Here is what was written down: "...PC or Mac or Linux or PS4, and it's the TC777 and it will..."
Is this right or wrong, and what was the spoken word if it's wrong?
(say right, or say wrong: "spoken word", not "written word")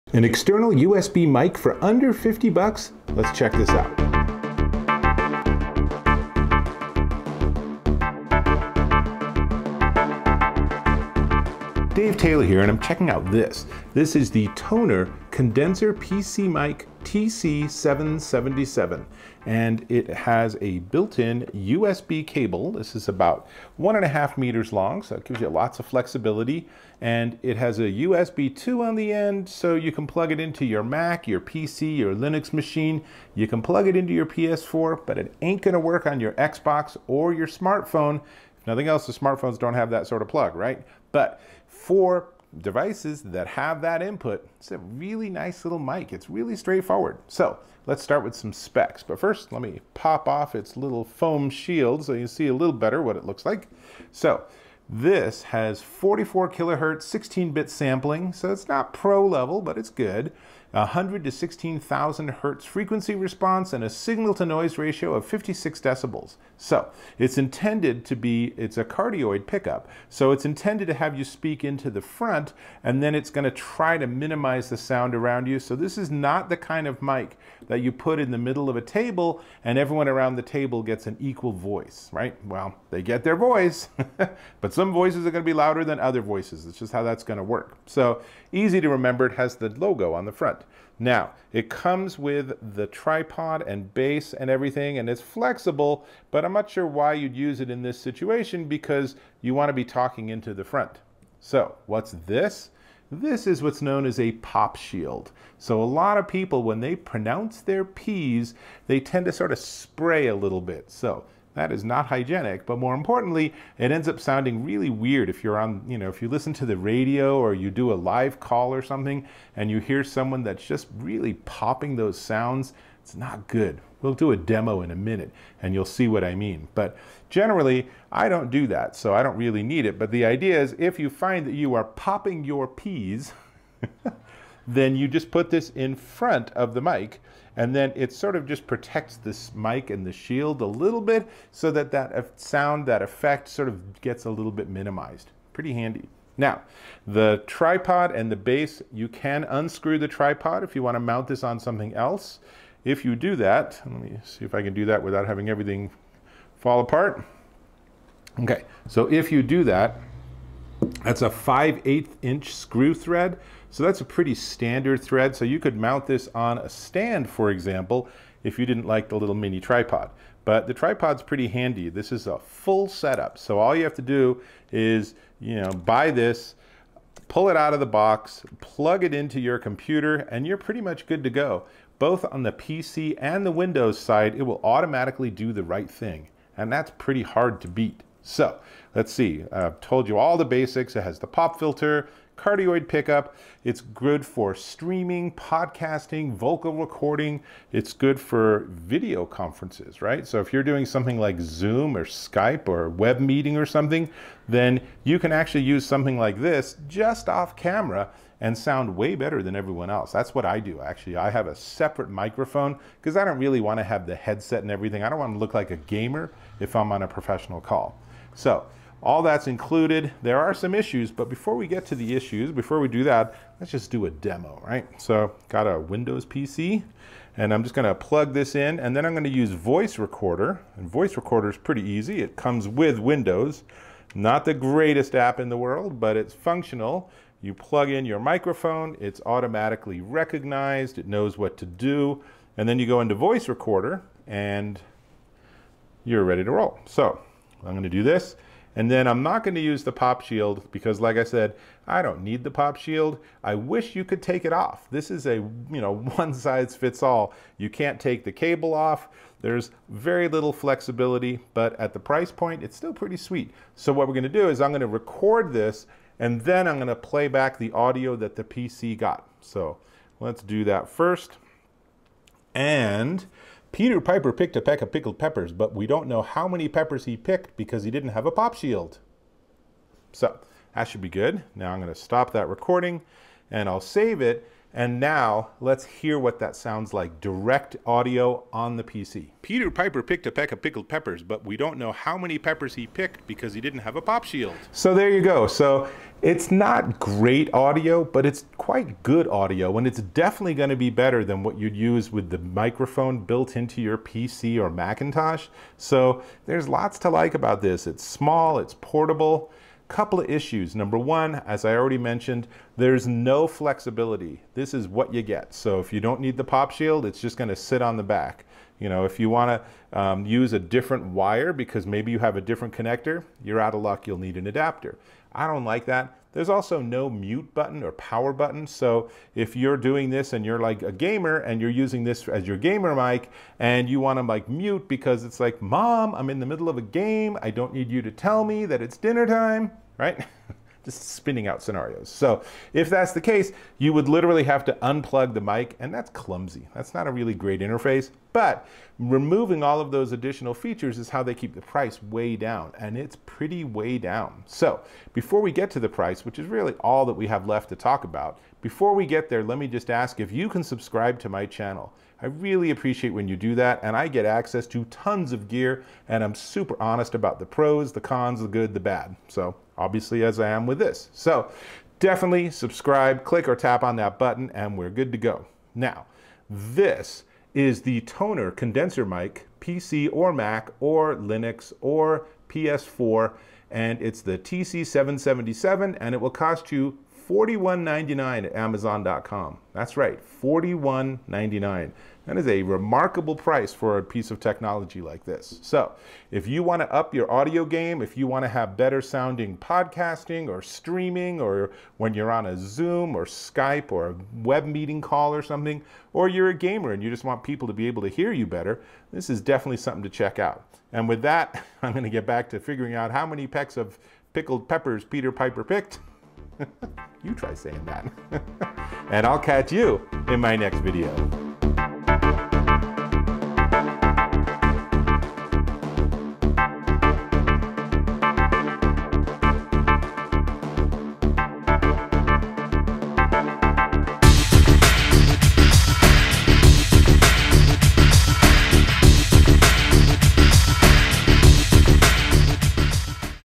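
right.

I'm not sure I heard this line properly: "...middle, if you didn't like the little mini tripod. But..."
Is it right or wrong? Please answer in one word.
wrong.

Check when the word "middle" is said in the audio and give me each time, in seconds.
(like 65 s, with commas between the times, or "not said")
78 s, 336 s.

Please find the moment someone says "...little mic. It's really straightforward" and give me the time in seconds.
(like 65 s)
45 s.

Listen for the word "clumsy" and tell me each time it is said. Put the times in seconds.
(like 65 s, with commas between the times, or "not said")
346 s.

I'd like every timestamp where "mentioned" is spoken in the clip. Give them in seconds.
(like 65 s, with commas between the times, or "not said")
311 s.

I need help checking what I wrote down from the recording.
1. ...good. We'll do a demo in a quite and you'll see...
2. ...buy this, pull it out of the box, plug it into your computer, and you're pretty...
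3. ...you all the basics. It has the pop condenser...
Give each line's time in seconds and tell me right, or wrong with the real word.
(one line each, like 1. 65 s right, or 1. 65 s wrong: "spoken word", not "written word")
1. 123 s wrong: "minute", not "quite"
2. 175 s right
3. 190 s wrong: "filter", not "condenser".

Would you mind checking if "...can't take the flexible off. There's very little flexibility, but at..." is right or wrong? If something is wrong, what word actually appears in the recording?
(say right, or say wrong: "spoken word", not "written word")
wrong: "cable", not "flexible".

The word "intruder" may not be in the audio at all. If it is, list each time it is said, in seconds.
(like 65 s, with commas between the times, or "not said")
not said.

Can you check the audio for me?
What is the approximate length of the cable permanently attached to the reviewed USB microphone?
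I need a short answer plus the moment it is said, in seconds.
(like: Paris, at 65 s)
1.5 meters, at 23 s.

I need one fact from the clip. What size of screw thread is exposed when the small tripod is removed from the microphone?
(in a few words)
5/8 inch.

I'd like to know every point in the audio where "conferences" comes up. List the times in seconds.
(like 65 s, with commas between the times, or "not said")
199 s.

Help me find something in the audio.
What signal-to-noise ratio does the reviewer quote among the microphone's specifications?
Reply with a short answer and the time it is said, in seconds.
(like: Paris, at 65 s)
56 decibels, at 65 s.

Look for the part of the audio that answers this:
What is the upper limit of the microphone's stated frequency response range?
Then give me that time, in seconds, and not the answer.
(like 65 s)
61 s.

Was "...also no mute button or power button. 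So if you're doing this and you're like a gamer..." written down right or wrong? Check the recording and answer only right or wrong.
right.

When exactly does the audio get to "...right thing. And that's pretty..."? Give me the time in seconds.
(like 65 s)
185 s.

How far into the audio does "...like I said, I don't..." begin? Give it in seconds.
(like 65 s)
251 s.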